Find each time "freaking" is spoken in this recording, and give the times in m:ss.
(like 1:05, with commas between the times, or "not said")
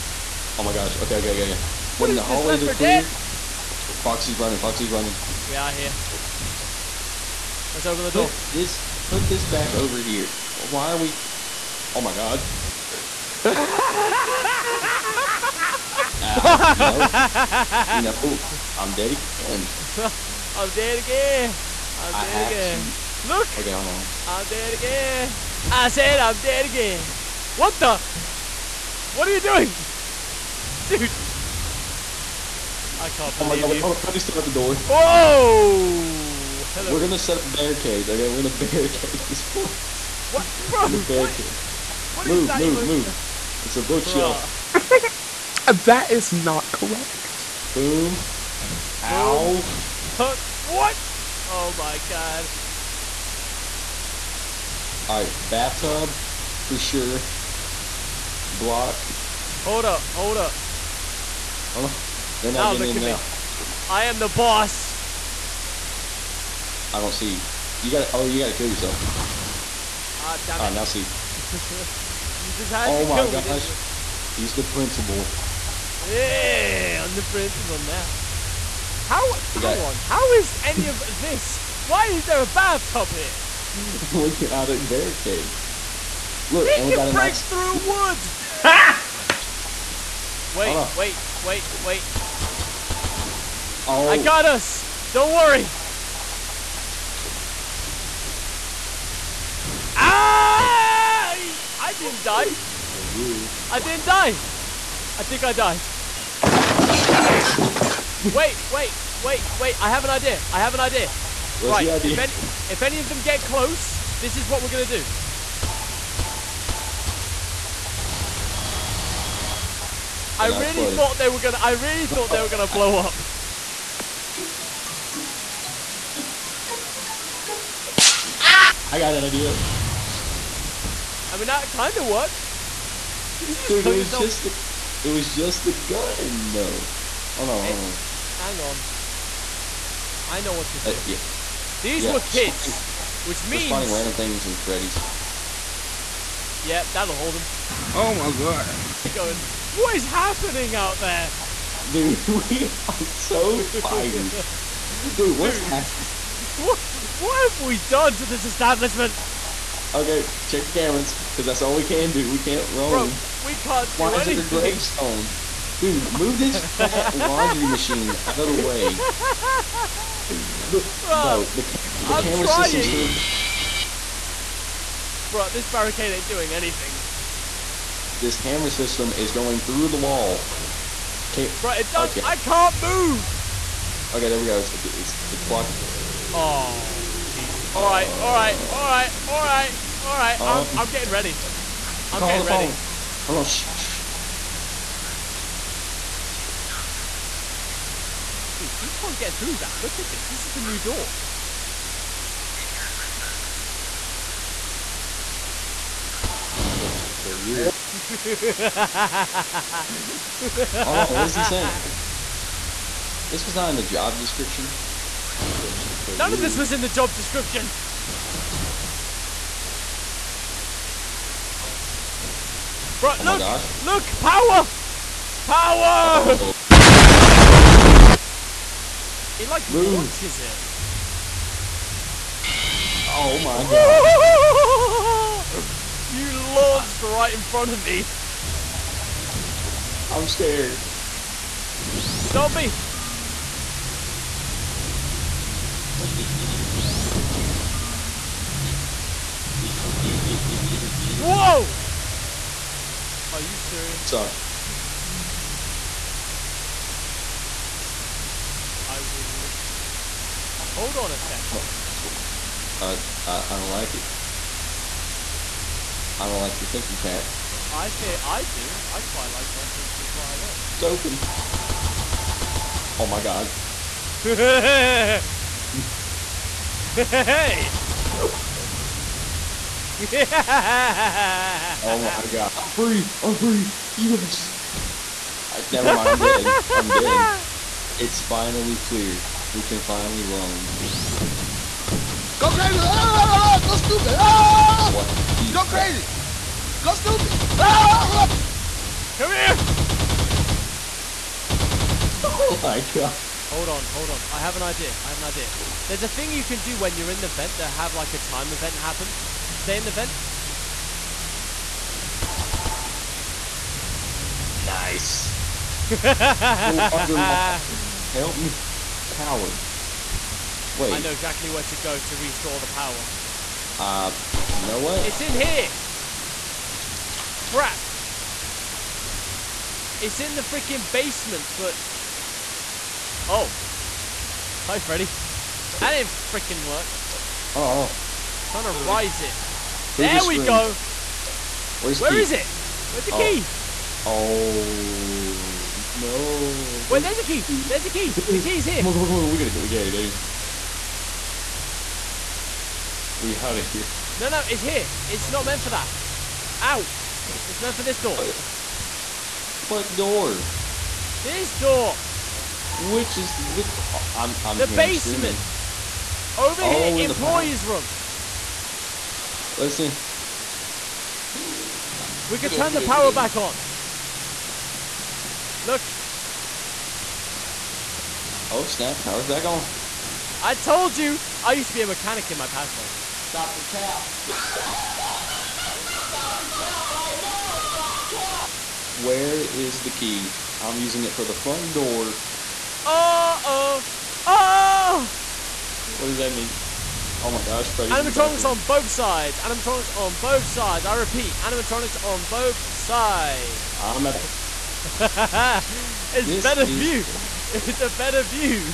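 5:30, 5:36.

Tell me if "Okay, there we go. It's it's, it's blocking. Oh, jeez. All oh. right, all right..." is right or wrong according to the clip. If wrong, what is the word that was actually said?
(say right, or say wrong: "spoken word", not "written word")
right.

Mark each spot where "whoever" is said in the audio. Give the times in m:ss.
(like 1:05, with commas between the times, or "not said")
not said.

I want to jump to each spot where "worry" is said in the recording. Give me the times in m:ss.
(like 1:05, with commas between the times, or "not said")
1:35.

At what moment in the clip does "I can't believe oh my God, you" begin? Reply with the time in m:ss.
0:32.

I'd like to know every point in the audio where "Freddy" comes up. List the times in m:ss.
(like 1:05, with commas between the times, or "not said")
0:33, 2:24, 5:34, 6:37.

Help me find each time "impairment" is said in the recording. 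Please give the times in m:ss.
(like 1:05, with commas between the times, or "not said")
not said.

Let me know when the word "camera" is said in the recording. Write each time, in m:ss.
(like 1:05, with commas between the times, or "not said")
2:40, 2:52, 2:58.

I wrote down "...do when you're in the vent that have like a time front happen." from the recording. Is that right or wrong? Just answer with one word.
wrong.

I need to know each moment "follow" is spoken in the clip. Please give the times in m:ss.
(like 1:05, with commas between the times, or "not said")
not said.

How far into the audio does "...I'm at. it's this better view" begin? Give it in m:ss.
6:43.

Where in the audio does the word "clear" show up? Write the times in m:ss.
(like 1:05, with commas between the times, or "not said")
0:02, 4:48.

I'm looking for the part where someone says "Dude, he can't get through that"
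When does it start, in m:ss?
3:18.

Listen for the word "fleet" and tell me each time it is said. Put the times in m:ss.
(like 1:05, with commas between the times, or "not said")
not said.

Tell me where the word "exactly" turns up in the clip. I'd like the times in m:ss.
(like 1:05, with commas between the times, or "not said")
5:21.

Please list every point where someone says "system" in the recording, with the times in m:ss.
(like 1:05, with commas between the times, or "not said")
2:52, 2:58.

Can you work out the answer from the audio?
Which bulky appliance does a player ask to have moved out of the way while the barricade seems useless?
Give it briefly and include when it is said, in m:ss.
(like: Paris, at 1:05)
laundry machine, at 2:47.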